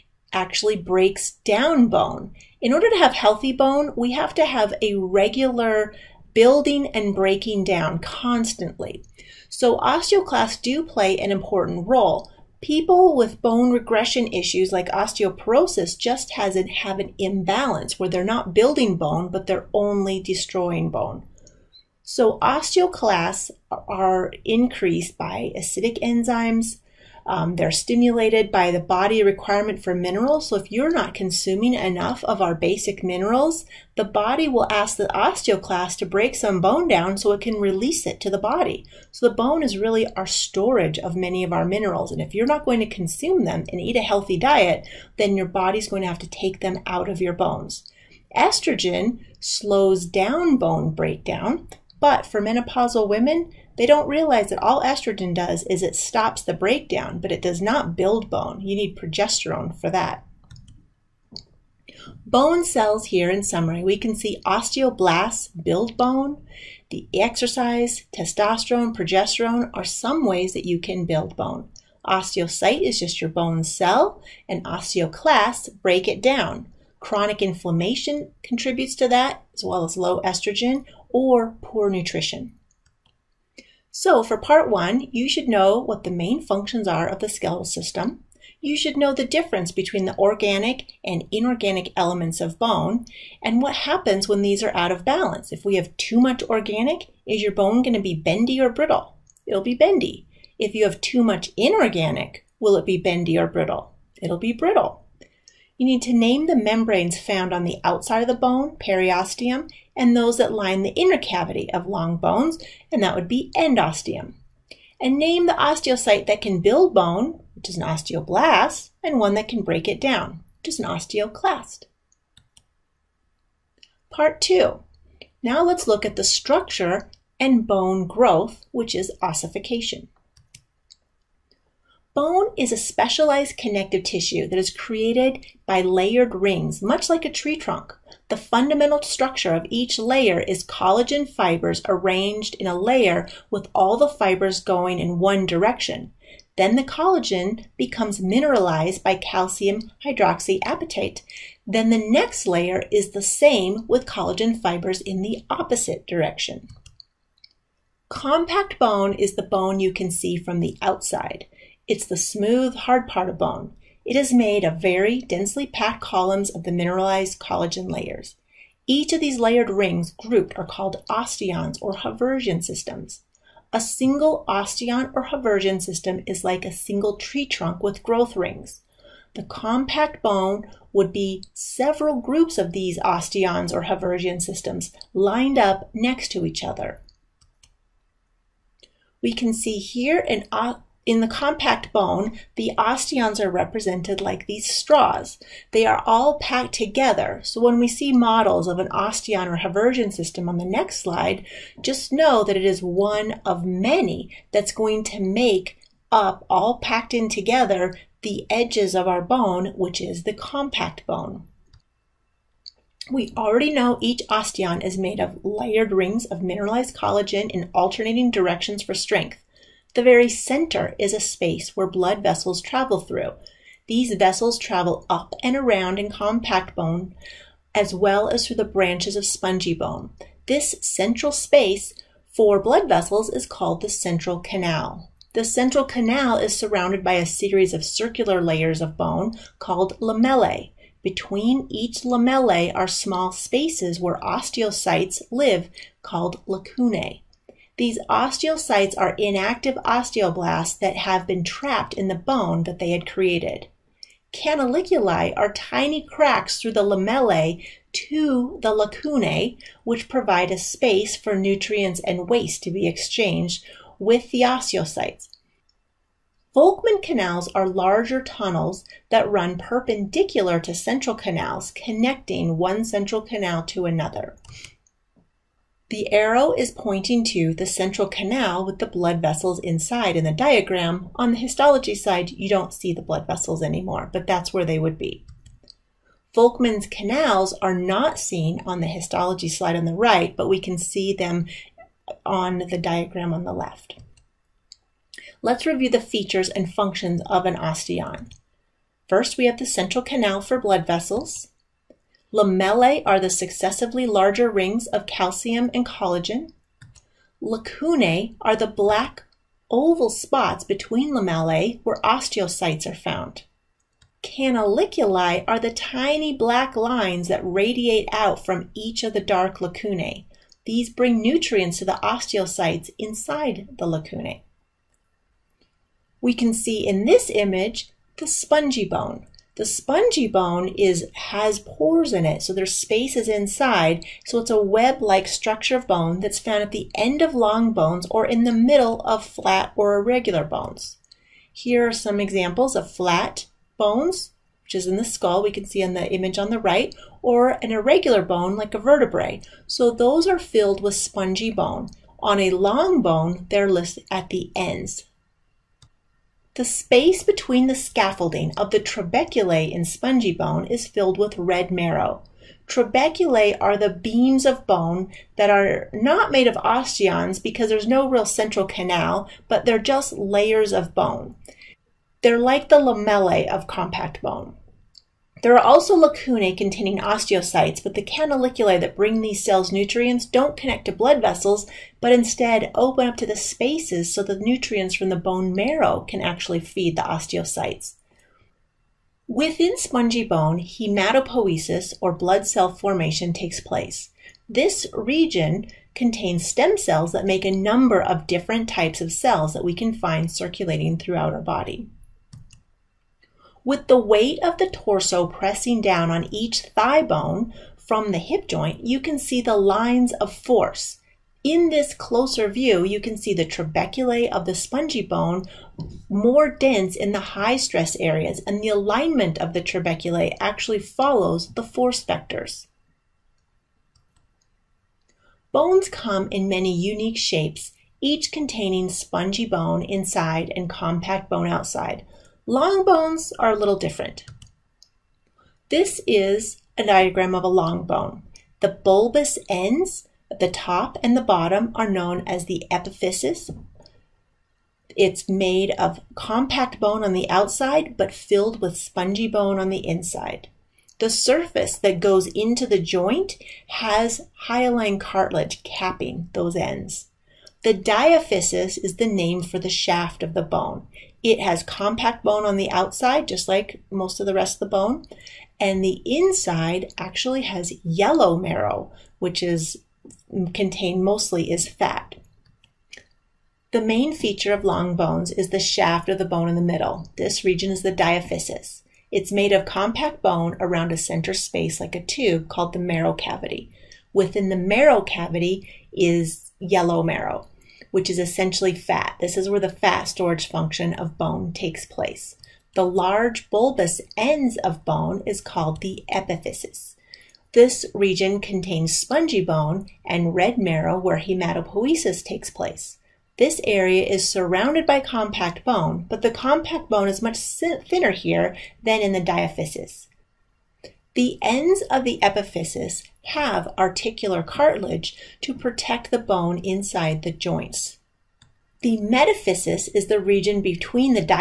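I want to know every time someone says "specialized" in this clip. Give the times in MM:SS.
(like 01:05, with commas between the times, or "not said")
02:12.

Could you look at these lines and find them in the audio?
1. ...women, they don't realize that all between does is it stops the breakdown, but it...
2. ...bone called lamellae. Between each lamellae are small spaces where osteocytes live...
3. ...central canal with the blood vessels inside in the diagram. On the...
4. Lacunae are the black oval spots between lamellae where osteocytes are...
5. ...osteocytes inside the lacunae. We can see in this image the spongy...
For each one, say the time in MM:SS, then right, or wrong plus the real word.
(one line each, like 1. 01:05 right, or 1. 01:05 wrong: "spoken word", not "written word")
1. 00:53 wrong: "estrogen", not "between"
2. 03:58 right
3. 04:37 right
4. 05:07 right
5. 05:22 right.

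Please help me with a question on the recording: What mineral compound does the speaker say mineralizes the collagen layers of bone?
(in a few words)
calcium hydroxyapatite.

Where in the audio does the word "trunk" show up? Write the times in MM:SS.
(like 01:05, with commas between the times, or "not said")
02:17, 02:57.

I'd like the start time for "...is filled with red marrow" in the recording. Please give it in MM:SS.
06:00.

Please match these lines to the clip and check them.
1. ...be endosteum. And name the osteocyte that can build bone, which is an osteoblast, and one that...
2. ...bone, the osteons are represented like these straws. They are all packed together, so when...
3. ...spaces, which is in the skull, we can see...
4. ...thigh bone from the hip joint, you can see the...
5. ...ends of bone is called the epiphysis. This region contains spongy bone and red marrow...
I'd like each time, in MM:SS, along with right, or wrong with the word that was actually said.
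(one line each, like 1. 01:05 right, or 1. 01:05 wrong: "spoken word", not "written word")
1. 01:53 right
2. 03:11 right
3. 05:43 wrong: "bones", not "spaces"
4. 06:46 right
5. 08:14 right.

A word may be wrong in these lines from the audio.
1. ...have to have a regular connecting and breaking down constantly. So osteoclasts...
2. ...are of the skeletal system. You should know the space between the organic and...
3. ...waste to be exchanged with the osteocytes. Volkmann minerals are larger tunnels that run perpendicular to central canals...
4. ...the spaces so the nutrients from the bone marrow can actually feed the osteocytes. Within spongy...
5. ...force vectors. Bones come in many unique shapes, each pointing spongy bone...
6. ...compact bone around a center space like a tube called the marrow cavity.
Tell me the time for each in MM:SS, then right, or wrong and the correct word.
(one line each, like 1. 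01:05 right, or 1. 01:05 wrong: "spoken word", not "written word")
1. 00:04 wrong: "building", not "connecting"
2. 01:26 wrong: "difference", not "space"
3. 04:22 wrong: "canals", not "minerals"
4. 06:23 right
5. 07:01 wrong: "containing", not "pointing"
6. 07:59 right.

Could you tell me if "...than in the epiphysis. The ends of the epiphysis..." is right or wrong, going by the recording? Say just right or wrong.
wrong.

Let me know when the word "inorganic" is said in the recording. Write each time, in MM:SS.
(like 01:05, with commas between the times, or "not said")
01:31, 01:41.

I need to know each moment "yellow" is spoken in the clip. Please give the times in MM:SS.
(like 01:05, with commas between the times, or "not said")
07:47, 08:06.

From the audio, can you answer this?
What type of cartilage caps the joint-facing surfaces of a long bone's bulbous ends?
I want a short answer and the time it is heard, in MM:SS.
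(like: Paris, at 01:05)
hyaline cartilage, at 07:34.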